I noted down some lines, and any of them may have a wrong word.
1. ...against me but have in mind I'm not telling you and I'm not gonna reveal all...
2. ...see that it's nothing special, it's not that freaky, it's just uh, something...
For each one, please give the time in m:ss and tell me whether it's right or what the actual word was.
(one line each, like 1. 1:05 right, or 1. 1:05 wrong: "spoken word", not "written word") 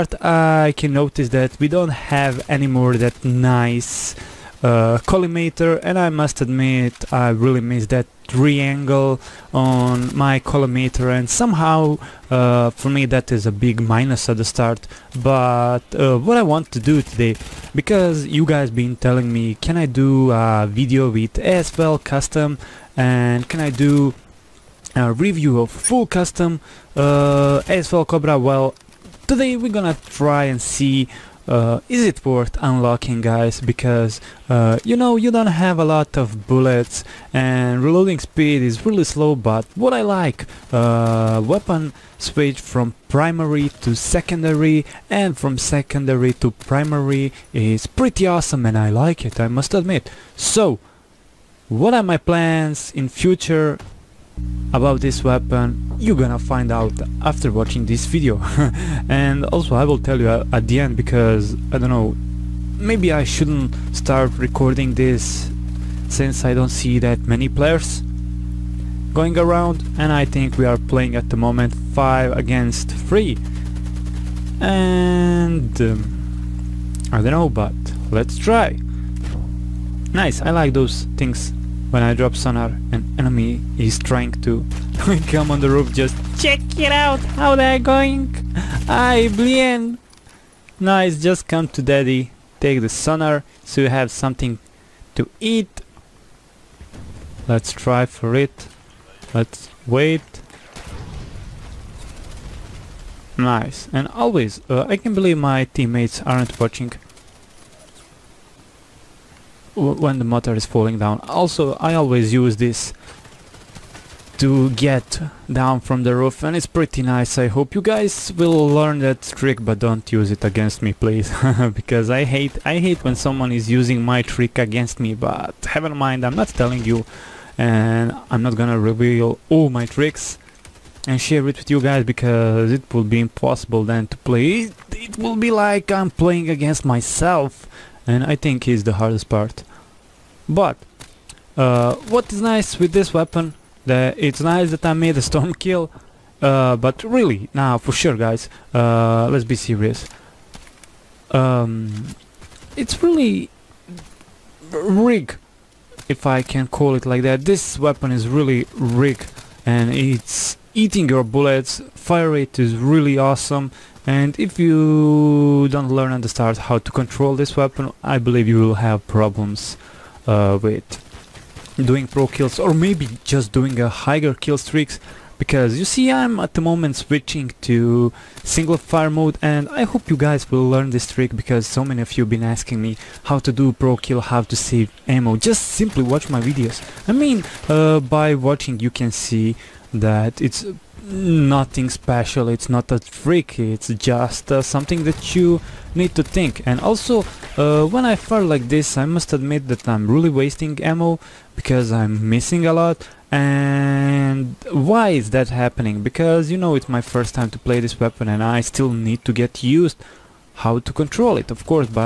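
1. 2:04 right
2. 3:09 right.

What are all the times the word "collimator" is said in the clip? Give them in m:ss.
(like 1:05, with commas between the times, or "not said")
0:05, 0:10.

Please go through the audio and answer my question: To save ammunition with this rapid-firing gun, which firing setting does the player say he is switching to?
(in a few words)
single fire mode.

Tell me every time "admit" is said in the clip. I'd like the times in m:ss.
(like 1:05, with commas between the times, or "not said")
0:06, 0:49, 3:19.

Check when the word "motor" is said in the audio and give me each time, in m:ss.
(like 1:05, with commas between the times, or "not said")
1:50.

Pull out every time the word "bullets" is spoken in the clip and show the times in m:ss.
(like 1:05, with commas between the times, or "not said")
0:36, 2:41.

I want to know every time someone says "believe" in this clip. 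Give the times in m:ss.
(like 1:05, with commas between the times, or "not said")
1:45, 2:48.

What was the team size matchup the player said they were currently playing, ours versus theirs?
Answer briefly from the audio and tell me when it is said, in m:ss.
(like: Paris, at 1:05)
5 against 3, at 1:11.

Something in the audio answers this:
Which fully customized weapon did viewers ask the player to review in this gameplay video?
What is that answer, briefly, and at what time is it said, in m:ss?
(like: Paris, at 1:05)
AS Val Cobra, at 0:27.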